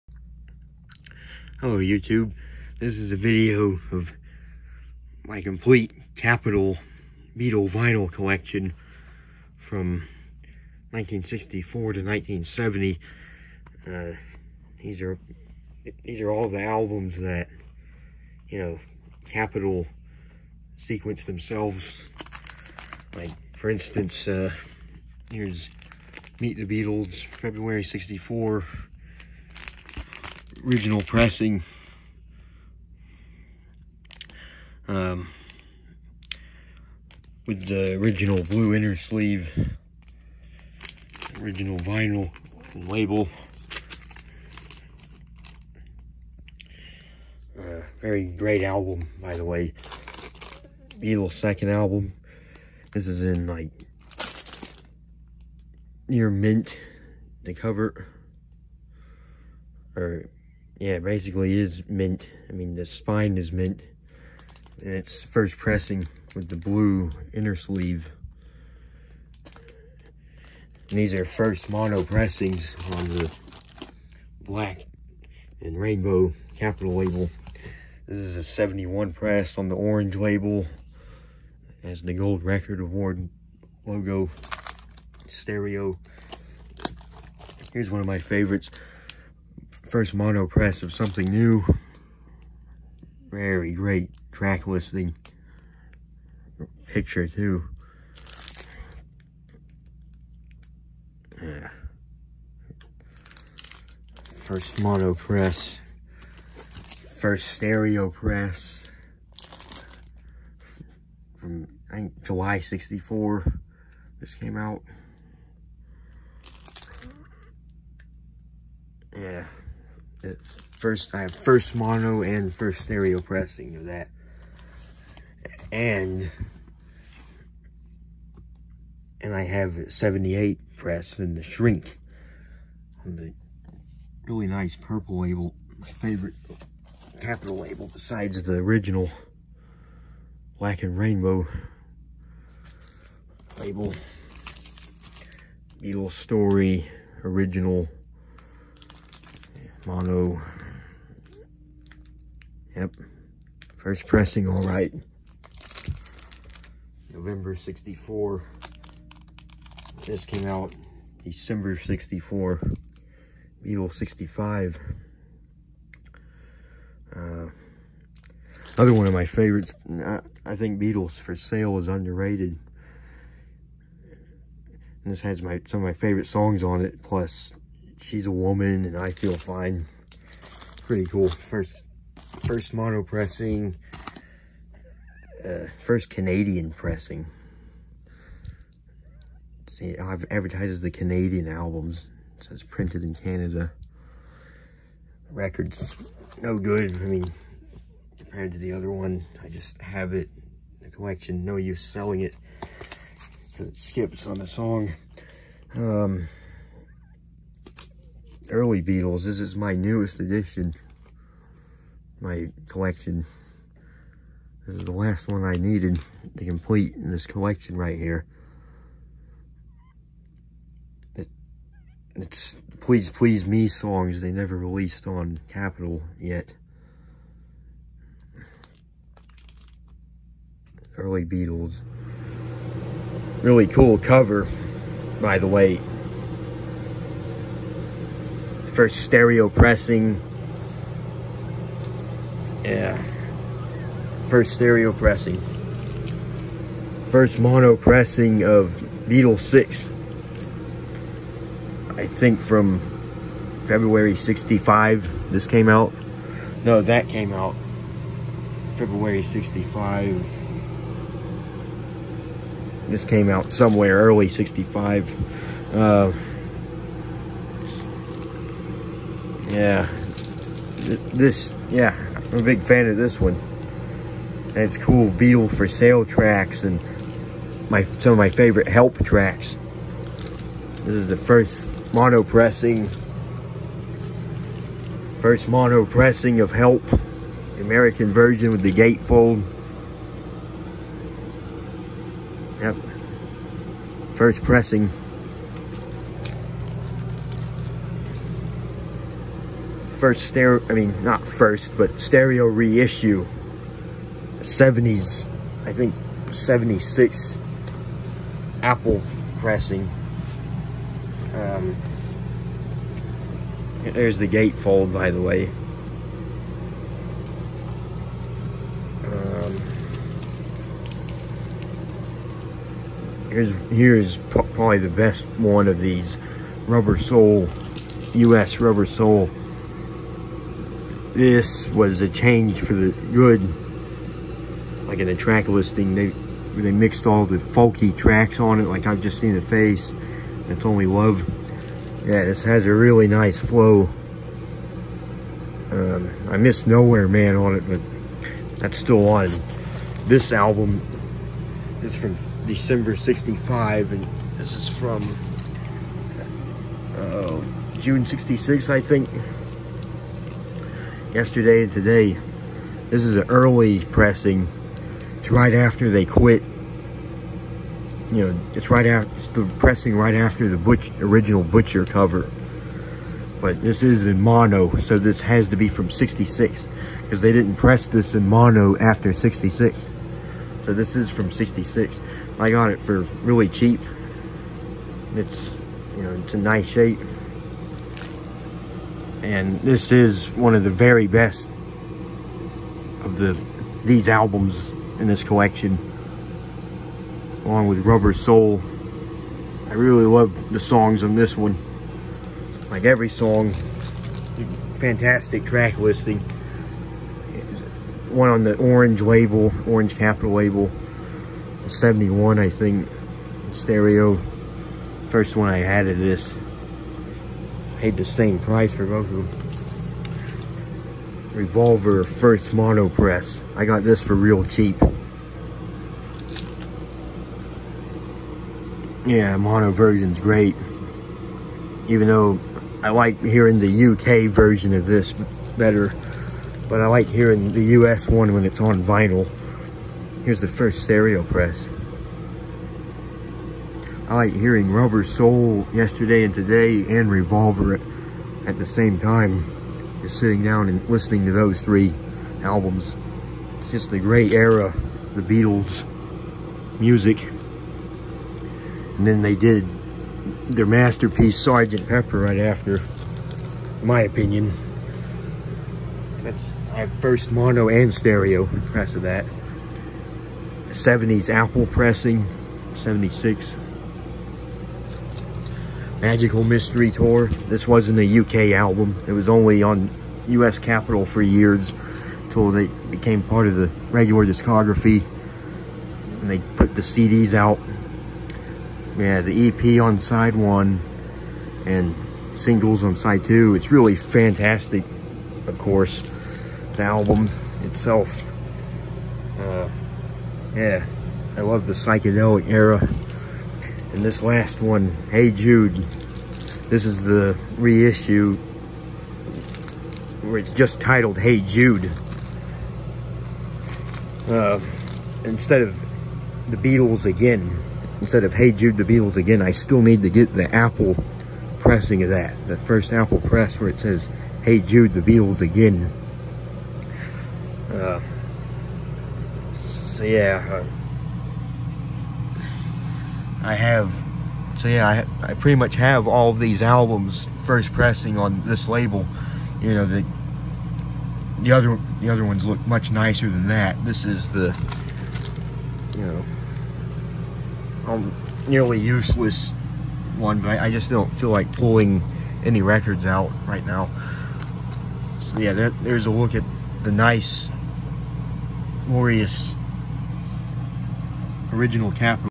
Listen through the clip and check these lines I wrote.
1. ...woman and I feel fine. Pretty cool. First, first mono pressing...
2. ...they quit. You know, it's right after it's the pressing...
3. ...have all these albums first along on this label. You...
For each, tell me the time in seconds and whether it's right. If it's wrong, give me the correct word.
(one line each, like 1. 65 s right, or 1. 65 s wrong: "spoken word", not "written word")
1. 178 s right
2. 365 s right
3. 535 s wrong: "pressing", not "along".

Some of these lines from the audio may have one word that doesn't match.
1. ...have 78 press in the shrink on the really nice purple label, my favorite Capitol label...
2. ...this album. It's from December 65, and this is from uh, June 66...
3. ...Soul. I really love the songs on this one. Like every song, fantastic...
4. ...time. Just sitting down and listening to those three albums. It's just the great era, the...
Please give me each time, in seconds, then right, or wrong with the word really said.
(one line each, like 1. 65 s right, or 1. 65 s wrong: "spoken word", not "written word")
1. 129 s right
2. 350 s right
3. 398 s right
4. 448 s right.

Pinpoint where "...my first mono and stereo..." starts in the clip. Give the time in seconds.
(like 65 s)
466 s.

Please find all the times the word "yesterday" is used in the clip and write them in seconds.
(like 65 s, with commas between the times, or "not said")
361 s, 445 s.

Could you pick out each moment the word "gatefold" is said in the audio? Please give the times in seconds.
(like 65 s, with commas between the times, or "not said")
288 s, 314 s.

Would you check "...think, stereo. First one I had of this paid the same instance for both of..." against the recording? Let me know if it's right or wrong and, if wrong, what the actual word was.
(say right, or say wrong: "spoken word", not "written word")
wrong: "price", not "instance".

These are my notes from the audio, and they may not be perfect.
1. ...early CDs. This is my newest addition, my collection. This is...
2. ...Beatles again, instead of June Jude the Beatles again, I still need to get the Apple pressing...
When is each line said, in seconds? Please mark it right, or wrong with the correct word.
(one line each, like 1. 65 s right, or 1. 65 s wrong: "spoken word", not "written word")
1. 208 s wrong: "Beatles", not "CDs"
2. 516 s wrong: "Hey", not "June".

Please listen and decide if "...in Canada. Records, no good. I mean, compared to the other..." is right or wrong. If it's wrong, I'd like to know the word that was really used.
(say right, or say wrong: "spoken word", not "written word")
right.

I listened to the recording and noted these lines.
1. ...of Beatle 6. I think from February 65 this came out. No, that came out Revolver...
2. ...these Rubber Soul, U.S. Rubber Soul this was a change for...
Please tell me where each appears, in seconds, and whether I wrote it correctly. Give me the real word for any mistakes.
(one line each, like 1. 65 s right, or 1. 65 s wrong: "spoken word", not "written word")
1. 248 s wrong: "February", not "Revolver"
2. 325 s right.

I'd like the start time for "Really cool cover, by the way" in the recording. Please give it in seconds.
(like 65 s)
233 s.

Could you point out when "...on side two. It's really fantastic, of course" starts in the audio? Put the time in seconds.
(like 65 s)
492 s.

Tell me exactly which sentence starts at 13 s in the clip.
Uh, these are these are all the albums that you know Capitol sequenced themselves.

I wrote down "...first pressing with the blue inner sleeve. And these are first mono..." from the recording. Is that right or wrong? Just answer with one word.
right.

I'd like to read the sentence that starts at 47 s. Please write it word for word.
Uh, very great album, by the way.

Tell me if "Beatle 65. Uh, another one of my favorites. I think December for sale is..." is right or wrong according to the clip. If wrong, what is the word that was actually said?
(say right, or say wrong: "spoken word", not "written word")
wrong: "Beatles", not "December".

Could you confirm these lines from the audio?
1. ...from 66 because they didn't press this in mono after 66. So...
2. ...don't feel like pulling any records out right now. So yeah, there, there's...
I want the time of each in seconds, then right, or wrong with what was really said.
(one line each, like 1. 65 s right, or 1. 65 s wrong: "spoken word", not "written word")
1. 375 s right
2. 550 s right.